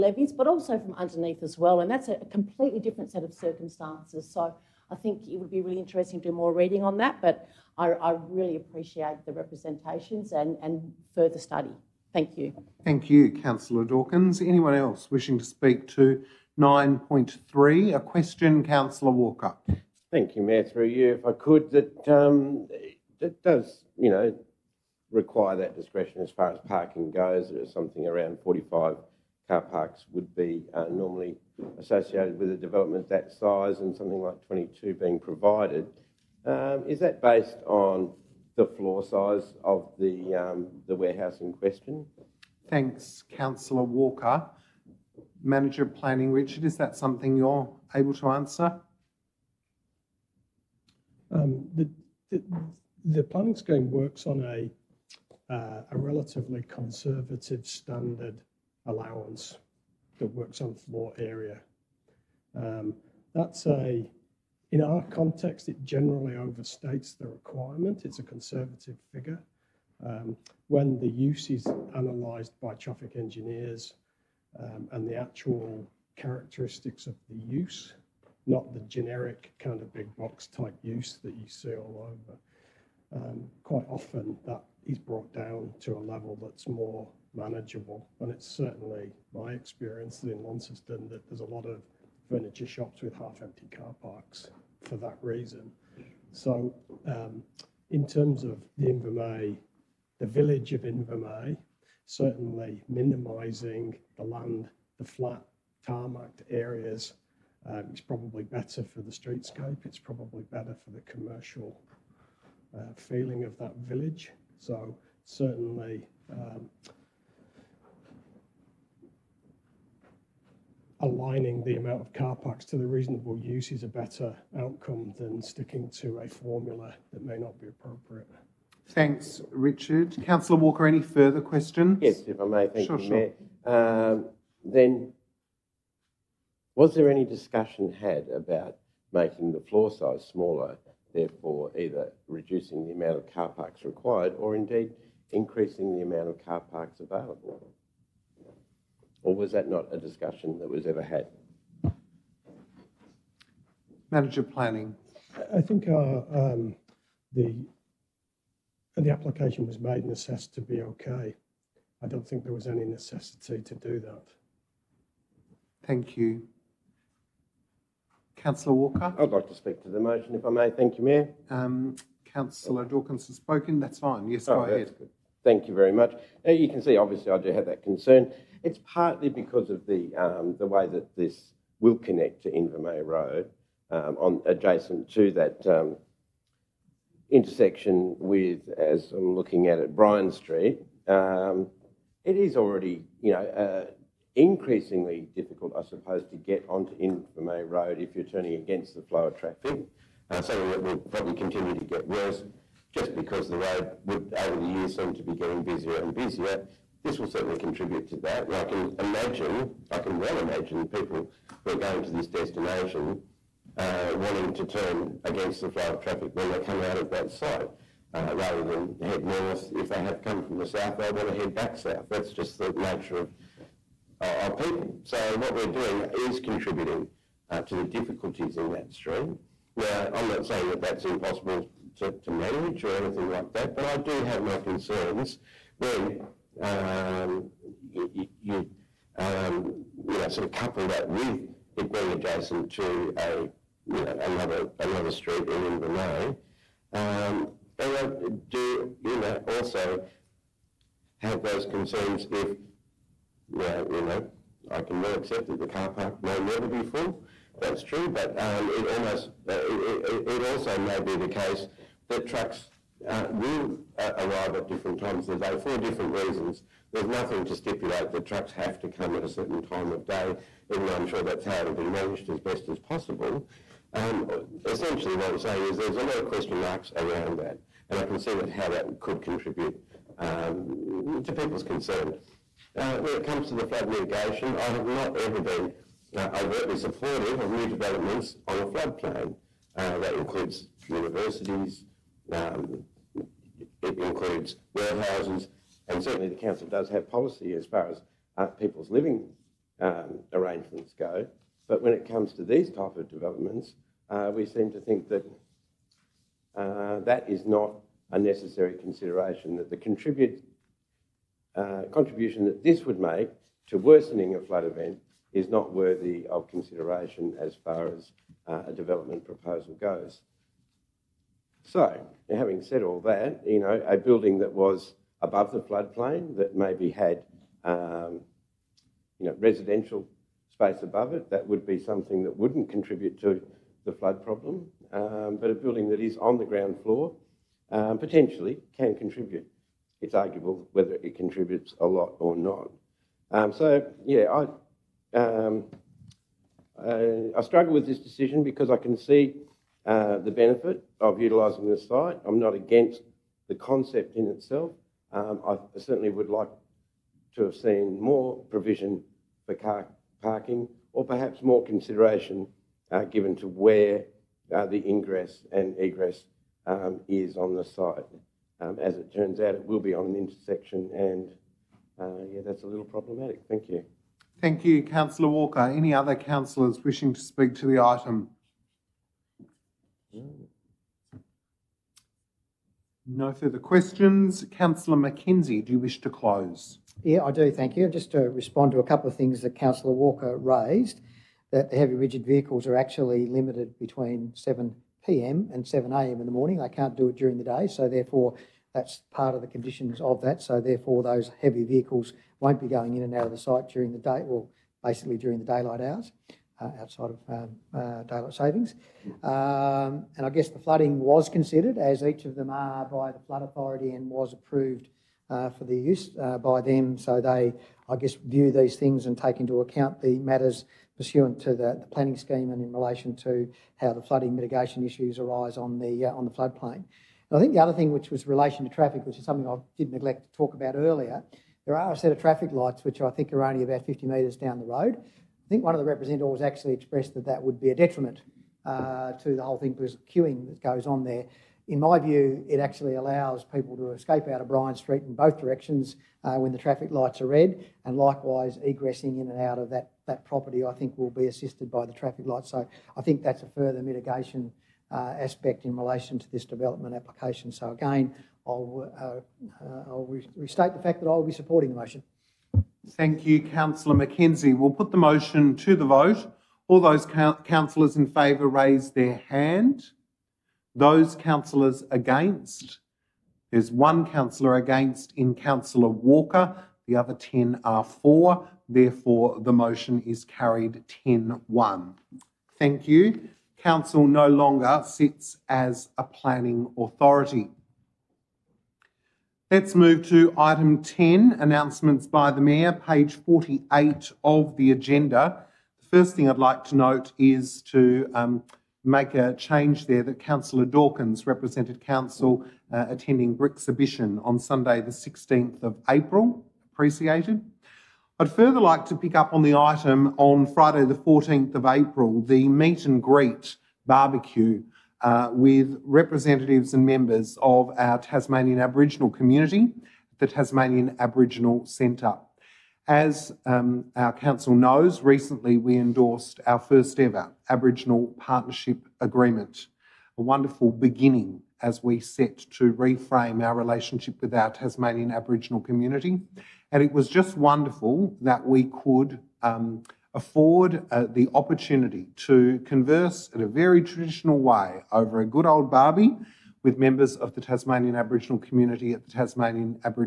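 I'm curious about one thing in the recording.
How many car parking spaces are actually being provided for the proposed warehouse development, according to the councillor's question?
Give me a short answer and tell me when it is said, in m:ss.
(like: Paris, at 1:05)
22, at 0:34.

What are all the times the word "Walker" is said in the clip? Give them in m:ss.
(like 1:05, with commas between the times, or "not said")
0:19, 0:43, 2:10, 2:48, 6:15, 6:29, 7:55.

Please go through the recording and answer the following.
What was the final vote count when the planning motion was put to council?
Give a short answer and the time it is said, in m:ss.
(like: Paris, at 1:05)
10 to 1, at 8:01.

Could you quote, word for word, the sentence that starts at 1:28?
And it's certainly my experience in Launceston that there's a lot of furniture shops with half-empty car parks for that reason.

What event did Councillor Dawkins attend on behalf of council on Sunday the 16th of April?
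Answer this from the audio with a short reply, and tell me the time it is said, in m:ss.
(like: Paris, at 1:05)
Brixhibition, at 8:23.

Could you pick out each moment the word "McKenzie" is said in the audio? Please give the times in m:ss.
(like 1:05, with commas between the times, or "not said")
6:24, 7:43.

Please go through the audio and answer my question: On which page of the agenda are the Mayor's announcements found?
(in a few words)
48.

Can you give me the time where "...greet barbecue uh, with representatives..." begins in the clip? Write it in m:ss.
8:33.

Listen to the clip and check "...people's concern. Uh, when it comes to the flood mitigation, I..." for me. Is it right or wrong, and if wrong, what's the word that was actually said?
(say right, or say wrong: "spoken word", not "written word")
right.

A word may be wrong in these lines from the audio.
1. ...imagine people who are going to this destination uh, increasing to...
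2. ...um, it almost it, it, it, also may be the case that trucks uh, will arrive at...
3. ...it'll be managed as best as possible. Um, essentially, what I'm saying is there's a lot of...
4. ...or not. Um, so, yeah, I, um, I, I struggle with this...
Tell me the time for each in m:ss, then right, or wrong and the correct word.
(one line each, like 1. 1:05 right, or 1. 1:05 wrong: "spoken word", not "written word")
1. 3:30 wrong: "wanting", not "increasing"
2. 4:18 right
3. 4:31 right
4. 5:42 right.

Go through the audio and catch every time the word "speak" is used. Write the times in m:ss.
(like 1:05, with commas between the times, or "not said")
0:15, 2:49, 6:17.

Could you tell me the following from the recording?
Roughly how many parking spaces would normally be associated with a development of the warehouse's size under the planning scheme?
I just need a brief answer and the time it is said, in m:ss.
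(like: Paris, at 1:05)
45, at 0:28.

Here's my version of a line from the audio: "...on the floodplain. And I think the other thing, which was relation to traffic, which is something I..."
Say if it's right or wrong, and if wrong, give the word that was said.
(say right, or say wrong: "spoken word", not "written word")
right.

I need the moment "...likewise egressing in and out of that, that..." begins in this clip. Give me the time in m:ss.
7:27.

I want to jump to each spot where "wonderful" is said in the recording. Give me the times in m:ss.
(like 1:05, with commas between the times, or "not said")
8:50, 8:57.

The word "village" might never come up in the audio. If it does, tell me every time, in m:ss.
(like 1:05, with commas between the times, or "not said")
1:40, 1:53.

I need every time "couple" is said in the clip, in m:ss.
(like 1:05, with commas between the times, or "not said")
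4:00, 6:28.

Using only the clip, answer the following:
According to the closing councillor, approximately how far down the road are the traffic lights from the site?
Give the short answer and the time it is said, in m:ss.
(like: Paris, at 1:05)
50 metres, at 7:13.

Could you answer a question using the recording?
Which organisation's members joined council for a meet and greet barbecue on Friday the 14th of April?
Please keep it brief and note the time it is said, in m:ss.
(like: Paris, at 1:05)
Tasmanian Aboriginal Centre, at 8:40.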